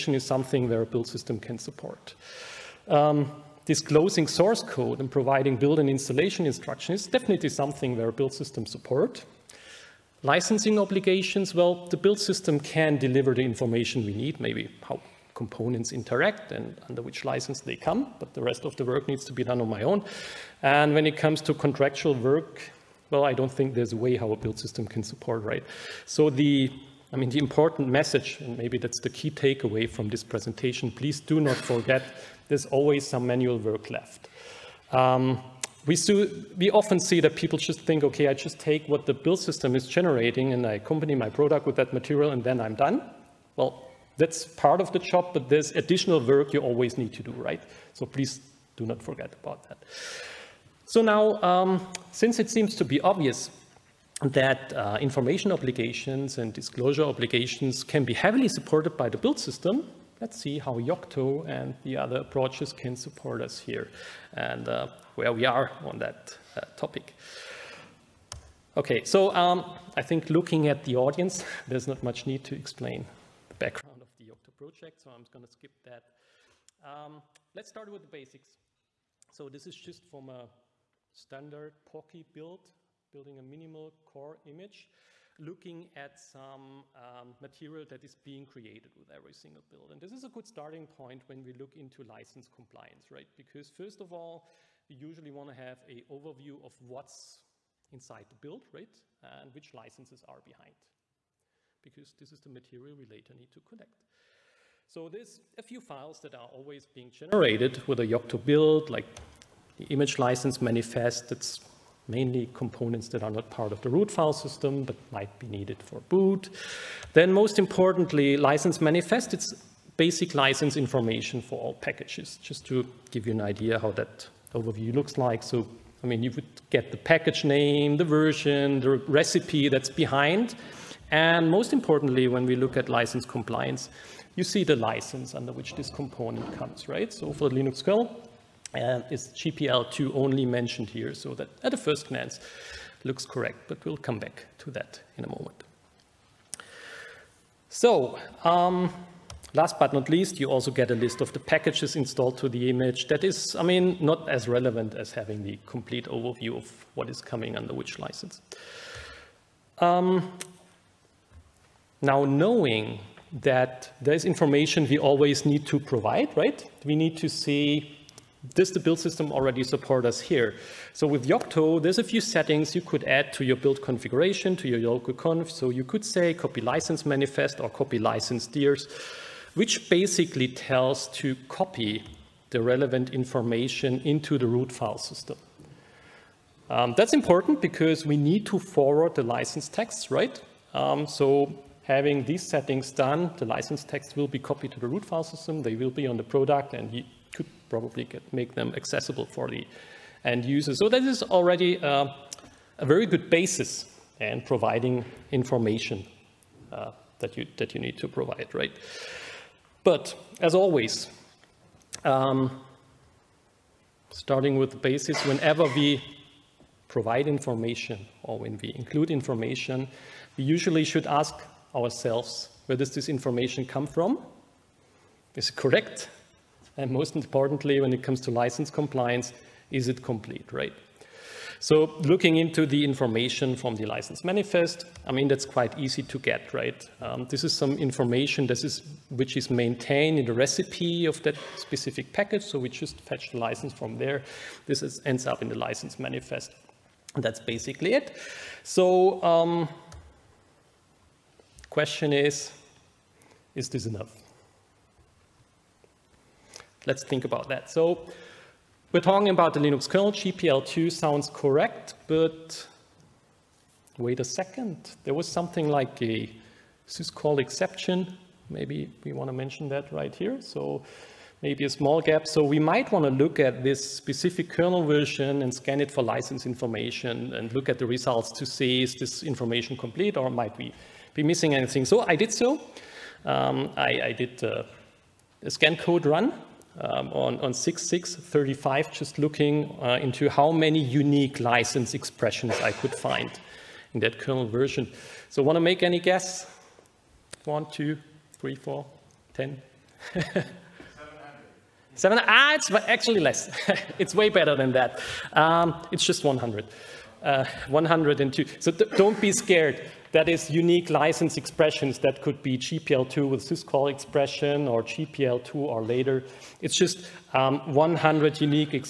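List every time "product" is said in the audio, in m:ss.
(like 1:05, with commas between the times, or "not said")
0:41, 3:16.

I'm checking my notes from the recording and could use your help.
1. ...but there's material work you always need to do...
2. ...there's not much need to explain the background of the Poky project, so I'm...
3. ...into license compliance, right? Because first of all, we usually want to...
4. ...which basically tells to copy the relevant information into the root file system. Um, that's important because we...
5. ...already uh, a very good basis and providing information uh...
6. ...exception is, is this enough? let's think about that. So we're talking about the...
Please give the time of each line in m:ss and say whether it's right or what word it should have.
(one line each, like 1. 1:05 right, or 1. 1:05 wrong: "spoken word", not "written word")
1. 0:45 wrong: "additional", not "material"
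2. 1:11 wrong: "Yocto", not "Poky"
3. 1:31 right
4. 2:59 right
5. 3:21 right
6. 4:11 wrong: "question", not "exception".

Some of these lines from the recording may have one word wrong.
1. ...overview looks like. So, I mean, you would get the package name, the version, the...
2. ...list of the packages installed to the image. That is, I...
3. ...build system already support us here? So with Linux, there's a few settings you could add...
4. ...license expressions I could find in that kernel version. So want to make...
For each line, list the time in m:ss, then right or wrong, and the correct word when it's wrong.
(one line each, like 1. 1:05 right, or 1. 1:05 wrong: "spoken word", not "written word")
1. 2:04 right
2. 2:30 right
3. 2:48 wrong: "Yocto", not "Linux"
4. 4:51 right.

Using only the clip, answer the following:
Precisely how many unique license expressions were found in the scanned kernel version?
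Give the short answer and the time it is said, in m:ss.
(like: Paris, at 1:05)
102, at 5:07.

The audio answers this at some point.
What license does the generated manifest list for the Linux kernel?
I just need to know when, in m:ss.
2:19.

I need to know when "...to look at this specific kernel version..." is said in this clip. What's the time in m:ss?
4:33.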